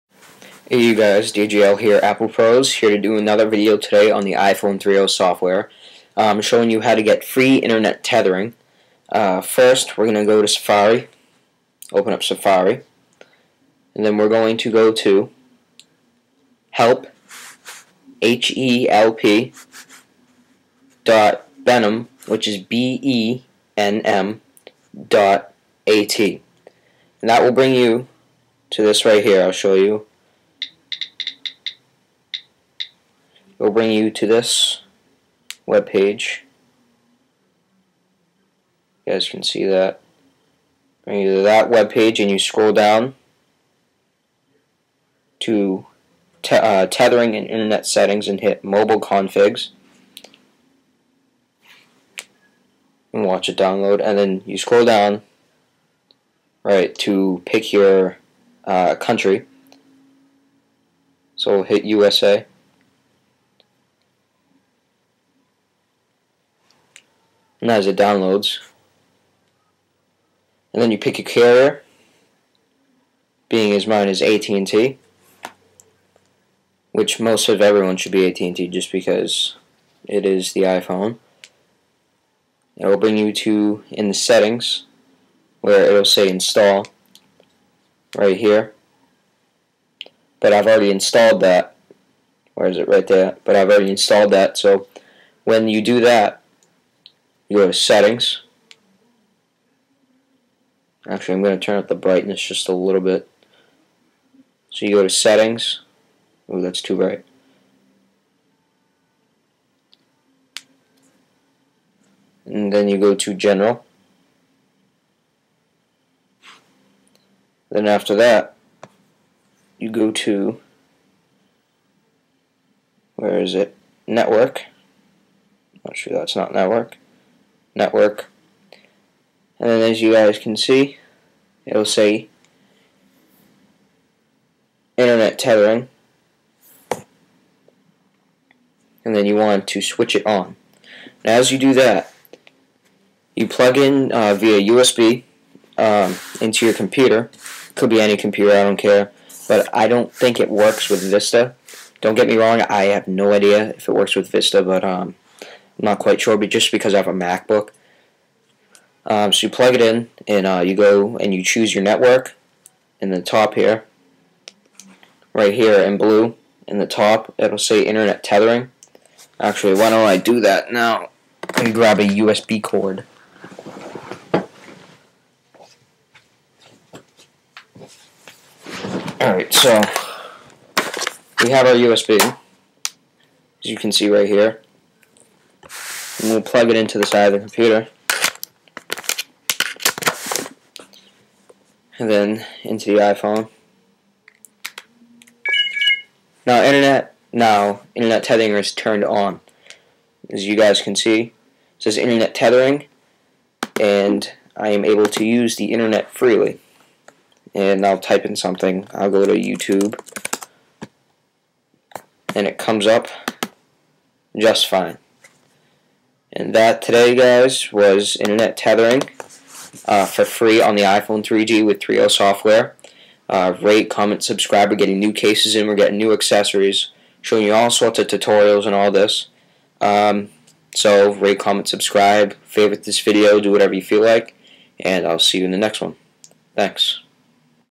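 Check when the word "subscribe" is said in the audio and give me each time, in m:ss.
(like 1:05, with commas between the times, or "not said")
3:44, 3:51.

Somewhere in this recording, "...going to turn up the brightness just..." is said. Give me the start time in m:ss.
1:41.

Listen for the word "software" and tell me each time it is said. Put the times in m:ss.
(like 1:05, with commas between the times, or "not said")
0:05, 3:42.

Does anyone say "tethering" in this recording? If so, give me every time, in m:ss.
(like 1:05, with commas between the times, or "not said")
0:08, 0:46, 2:15, 2:48, 3:18, 3:22, 3:38.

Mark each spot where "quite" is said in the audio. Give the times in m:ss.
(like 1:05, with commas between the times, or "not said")
2:35.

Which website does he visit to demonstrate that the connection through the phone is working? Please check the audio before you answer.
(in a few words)
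YouTube.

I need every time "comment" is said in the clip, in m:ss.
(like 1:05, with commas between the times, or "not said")
3:43, 3:51.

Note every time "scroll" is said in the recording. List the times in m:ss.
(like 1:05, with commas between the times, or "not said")
0:42, 0:54.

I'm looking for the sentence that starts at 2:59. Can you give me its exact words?
Alright, so we have our USB, as you can see right here.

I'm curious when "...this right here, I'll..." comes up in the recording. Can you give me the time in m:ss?
0:28.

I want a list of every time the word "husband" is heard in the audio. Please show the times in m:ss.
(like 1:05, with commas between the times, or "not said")
not said.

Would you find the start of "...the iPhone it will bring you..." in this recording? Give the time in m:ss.
1:20.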